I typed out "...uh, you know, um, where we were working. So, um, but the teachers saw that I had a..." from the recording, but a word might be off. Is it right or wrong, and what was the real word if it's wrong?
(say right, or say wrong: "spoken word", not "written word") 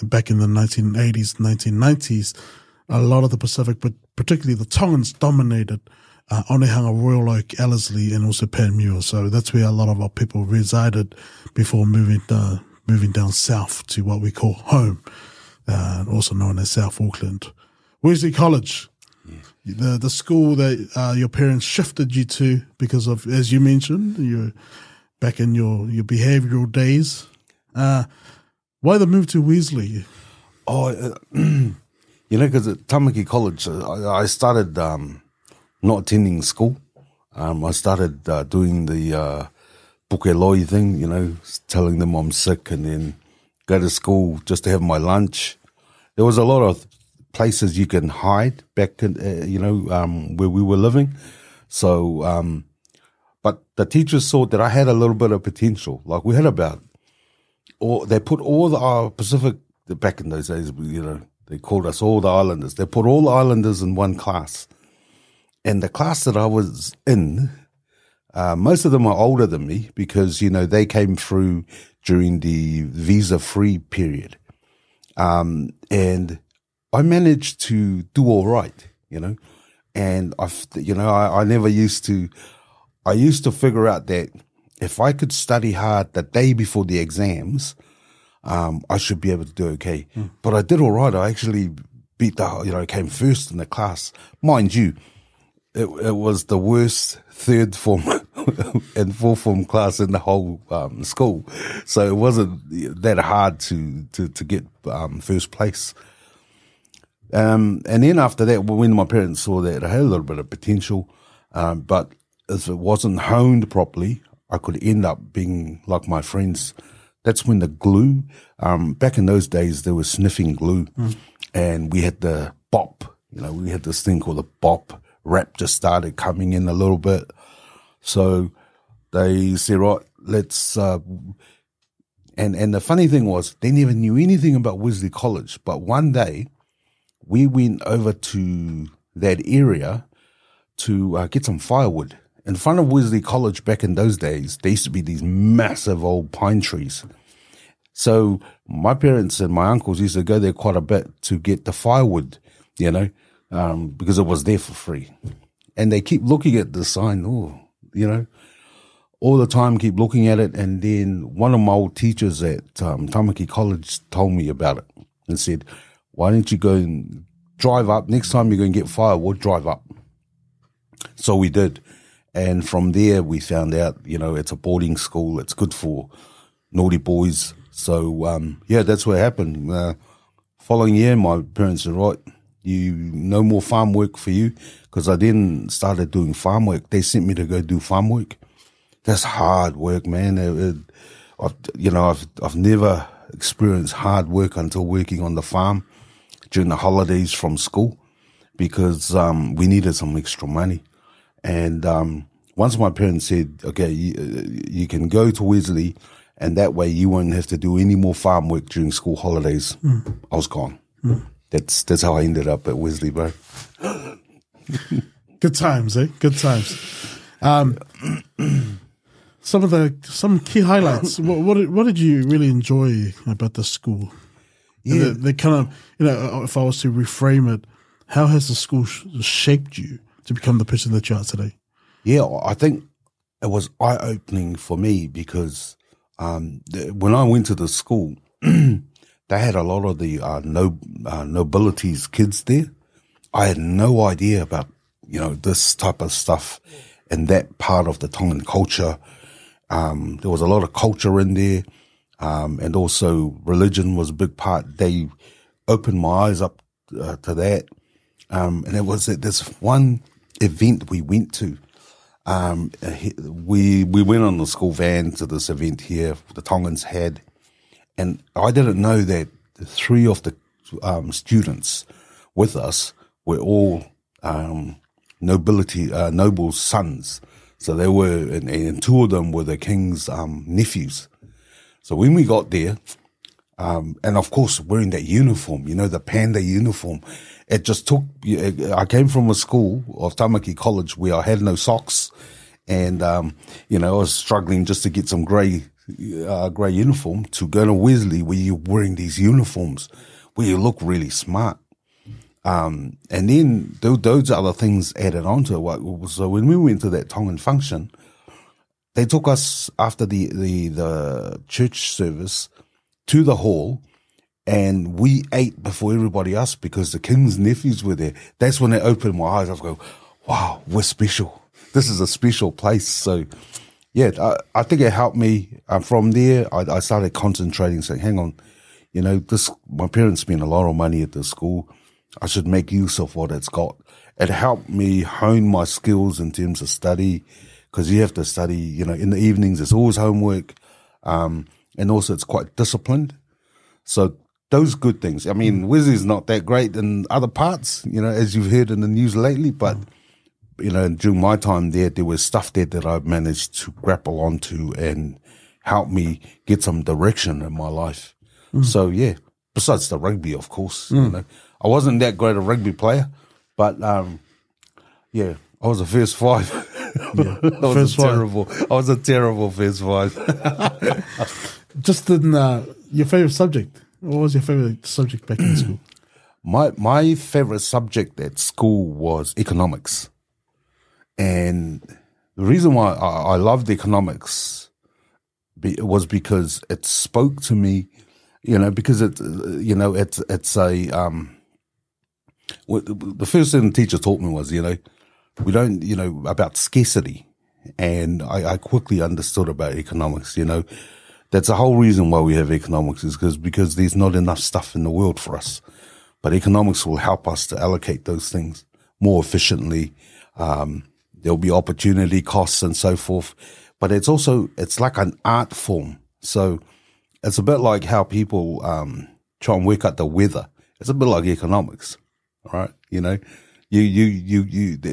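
wrong: "living", not "working".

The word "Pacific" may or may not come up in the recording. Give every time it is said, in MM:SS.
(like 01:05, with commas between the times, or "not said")
00:03, 00:59.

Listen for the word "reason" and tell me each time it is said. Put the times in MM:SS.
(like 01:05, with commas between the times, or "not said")
06:22, 06:41.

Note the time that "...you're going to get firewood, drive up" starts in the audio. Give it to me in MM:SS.
02:48.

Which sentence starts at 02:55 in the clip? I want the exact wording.
It's good for naughty boys so um, yeah, that's what happened.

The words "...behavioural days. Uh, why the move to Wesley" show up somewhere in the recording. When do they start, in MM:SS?
00:26.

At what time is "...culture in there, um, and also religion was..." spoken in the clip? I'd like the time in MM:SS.
04:10.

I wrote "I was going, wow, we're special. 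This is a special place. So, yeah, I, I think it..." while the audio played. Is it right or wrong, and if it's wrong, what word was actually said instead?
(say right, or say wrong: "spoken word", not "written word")
right.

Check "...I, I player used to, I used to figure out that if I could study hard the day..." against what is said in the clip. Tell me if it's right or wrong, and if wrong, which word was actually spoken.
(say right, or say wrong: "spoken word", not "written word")
wrong: "never", not "player".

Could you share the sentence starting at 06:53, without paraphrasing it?
But it's also, it's like an art form.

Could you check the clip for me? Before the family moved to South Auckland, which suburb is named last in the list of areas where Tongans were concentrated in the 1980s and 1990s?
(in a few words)
Panmure.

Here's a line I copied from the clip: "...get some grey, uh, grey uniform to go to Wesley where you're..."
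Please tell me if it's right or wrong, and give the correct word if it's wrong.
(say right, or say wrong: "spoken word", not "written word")
right.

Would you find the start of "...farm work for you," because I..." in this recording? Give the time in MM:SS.
03:03.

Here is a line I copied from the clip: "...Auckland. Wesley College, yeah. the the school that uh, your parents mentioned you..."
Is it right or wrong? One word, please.
wrong.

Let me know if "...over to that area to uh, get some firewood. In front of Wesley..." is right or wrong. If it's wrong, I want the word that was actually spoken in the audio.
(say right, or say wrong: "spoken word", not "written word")
right.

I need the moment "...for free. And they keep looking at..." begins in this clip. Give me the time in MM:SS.
02:34.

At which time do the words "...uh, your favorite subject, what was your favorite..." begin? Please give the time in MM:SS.
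06:12.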